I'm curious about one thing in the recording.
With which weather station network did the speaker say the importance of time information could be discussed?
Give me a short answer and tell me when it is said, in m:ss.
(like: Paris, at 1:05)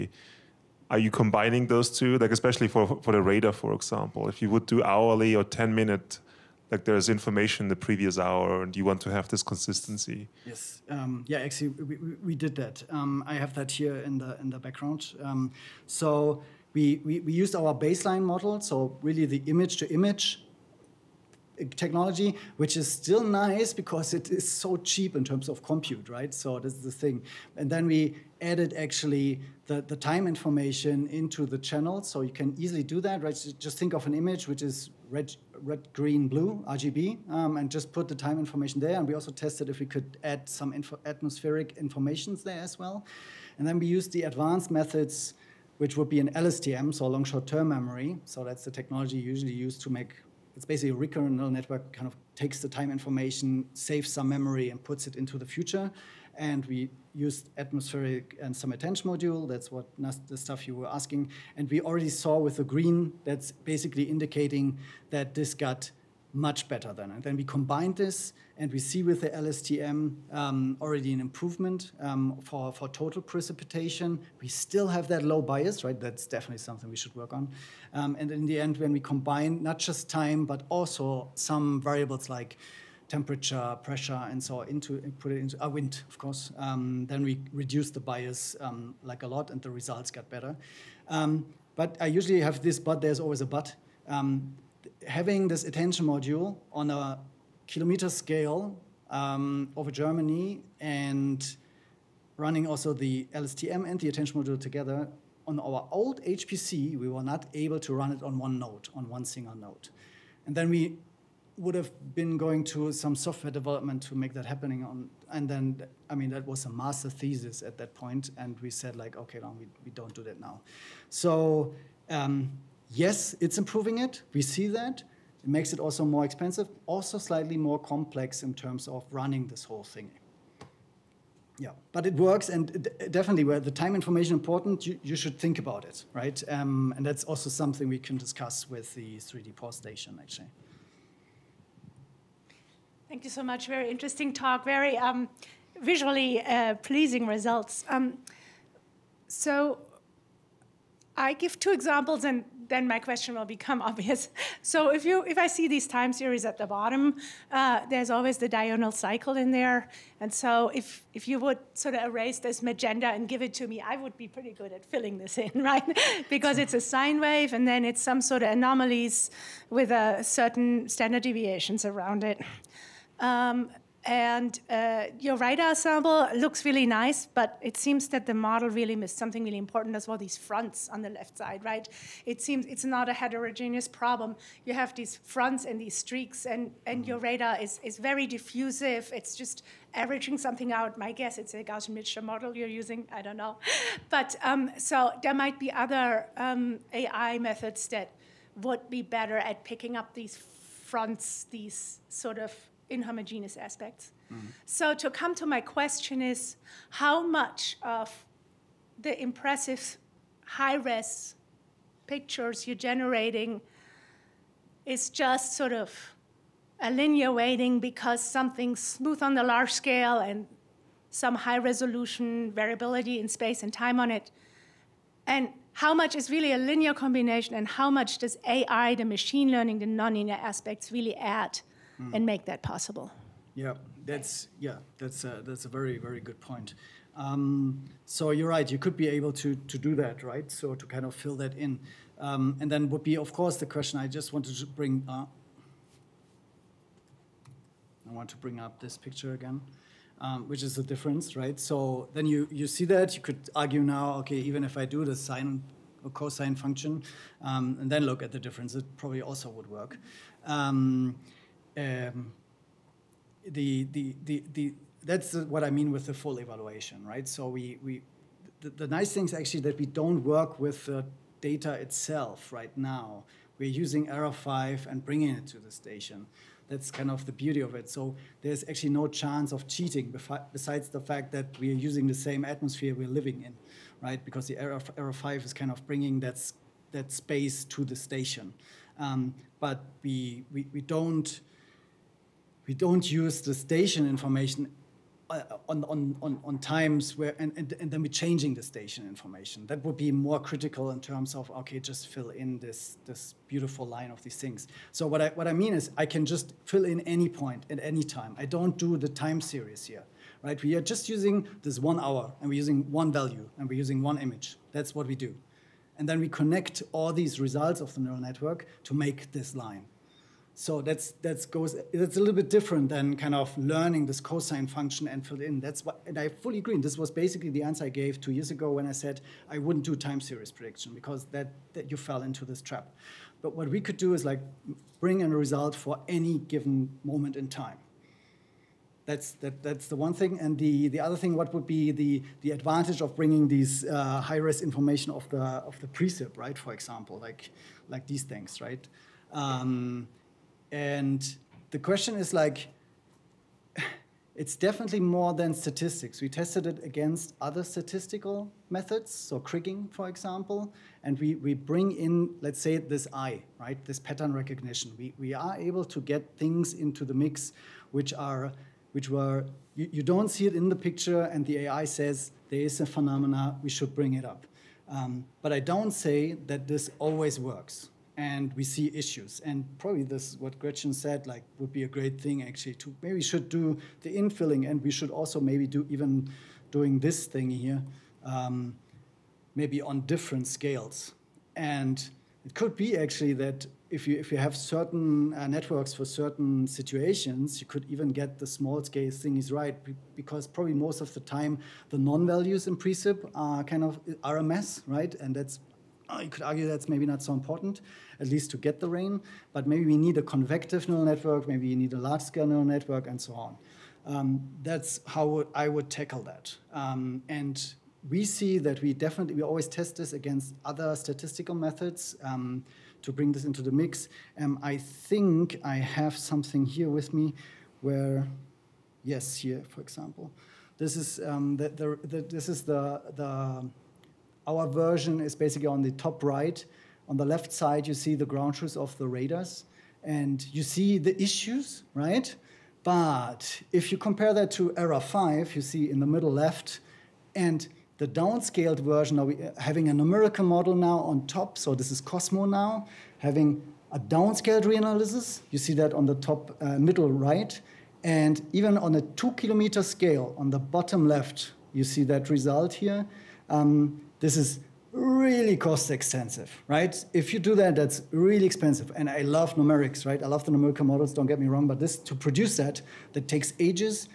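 3D-PAWS, at 2:19.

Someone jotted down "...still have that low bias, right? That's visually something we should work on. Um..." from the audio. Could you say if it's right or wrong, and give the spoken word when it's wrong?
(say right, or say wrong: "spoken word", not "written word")
wrong: "definitely", not "visually".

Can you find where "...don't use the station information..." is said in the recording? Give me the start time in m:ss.
4:52.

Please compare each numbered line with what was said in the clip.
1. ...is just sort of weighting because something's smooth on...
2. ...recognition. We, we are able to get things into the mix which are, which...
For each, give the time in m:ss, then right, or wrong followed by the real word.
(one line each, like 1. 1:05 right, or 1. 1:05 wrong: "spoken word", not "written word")
1. 3:34 right
2. 6:04 right.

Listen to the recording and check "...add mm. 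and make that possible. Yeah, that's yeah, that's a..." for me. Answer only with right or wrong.
right.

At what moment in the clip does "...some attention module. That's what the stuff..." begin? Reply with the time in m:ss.
0:58.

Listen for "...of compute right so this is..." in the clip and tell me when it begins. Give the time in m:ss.
0:25.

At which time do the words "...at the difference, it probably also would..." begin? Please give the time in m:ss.
4:18.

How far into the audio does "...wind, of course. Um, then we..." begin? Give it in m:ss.
1:25.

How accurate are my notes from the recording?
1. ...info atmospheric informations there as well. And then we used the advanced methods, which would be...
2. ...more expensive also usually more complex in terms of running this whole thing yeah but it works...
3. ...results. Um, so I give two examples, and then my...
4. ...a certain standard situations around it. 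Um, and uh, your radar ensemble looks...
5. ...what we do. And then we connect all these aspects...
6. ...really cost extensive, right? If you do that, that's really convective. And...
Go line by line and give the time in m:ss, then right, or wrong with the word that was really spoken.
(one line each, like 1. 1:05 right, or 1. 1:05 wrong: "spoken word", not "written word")
1. 0:40 right
2. 2:06 wrong: "slightly", not "usually"
3. 2:27 right
4. 2:49 wrong: "deviations", not "situations"
5. 5:14 wrong: "results", not "aspects"
6. 7:44 wrong: "expensive", not "convective".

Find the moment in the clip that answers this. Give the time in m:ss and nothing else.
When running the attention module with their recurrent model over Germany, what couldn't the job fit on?
1:49.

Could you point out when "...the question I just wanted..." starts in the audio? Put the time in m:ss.
4:03.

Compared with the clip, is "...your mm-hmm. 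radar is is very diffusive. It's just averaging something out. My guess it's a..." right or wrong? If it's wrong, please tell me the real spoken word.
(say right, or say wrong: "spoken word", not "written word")
right.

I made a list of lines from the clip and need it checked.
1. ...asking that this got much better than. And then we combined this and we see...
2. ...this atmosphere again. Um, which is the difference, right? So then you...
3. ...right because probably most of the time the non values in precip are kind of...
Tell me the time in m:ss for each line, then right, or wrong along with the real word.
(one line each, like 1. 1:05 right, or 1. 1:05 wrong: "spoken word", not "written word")
1. 1:04 wrong: "indicating", not "asking"
2. 4:08 wrong: "picture", not "atmosphere"
3. 6:39 right.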